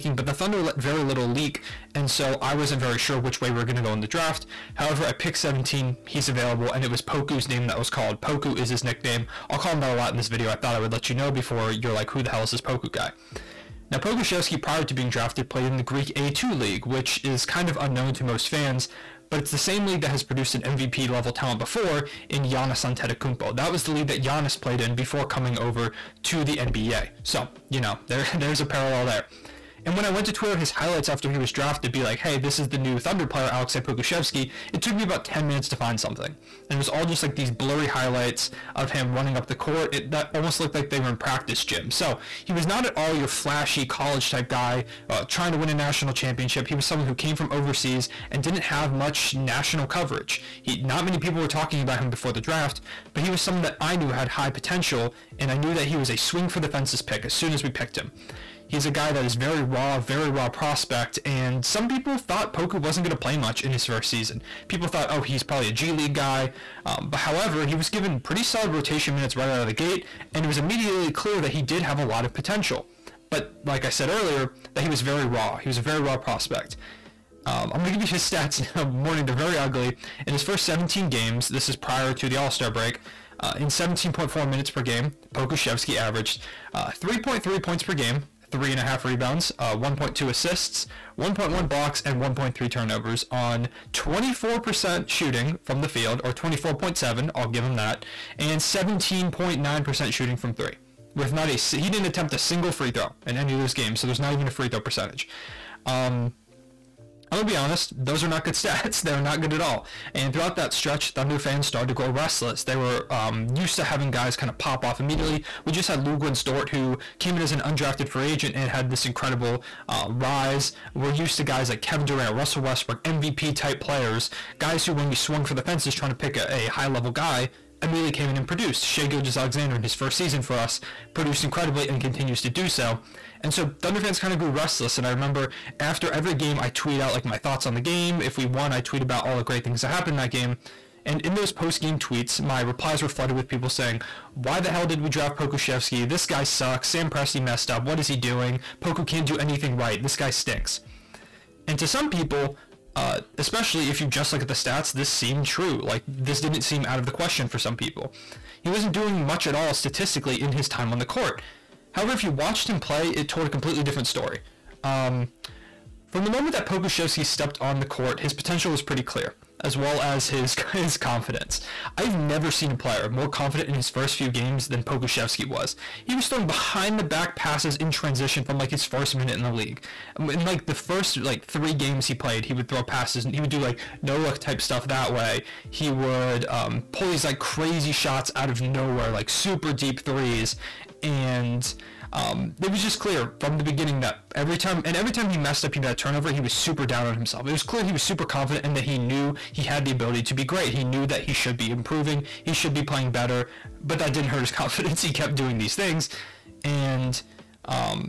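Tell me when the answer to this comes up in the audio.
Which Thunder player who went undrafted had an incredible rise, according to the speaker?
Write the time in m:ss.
1:56.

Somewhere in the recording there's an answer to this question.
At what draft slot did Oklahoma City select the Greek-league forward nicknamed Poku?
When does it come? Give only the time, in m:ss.
0:05.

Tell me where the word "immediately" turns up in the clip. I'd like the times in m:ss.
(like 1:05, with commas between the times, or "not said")
1:10, 1:55, 2:07.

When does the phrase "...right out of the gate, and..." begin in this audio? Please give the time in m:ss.
1:09.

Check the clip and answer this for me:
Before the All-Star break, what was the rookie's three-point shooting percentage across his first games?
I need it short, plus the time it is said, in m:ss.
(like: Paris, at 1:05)
17.9%, at 1:38.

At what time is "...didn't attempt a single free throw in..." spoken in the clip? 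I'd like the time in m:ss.
1:41.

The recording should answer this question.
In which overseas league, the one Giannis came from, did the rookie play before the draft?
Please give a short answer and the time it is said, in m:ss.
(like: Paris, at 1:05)
Greek A2 League, at 0:15.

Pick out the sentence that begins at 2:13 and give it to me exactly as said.
And so Thunder fans kind of grew restless.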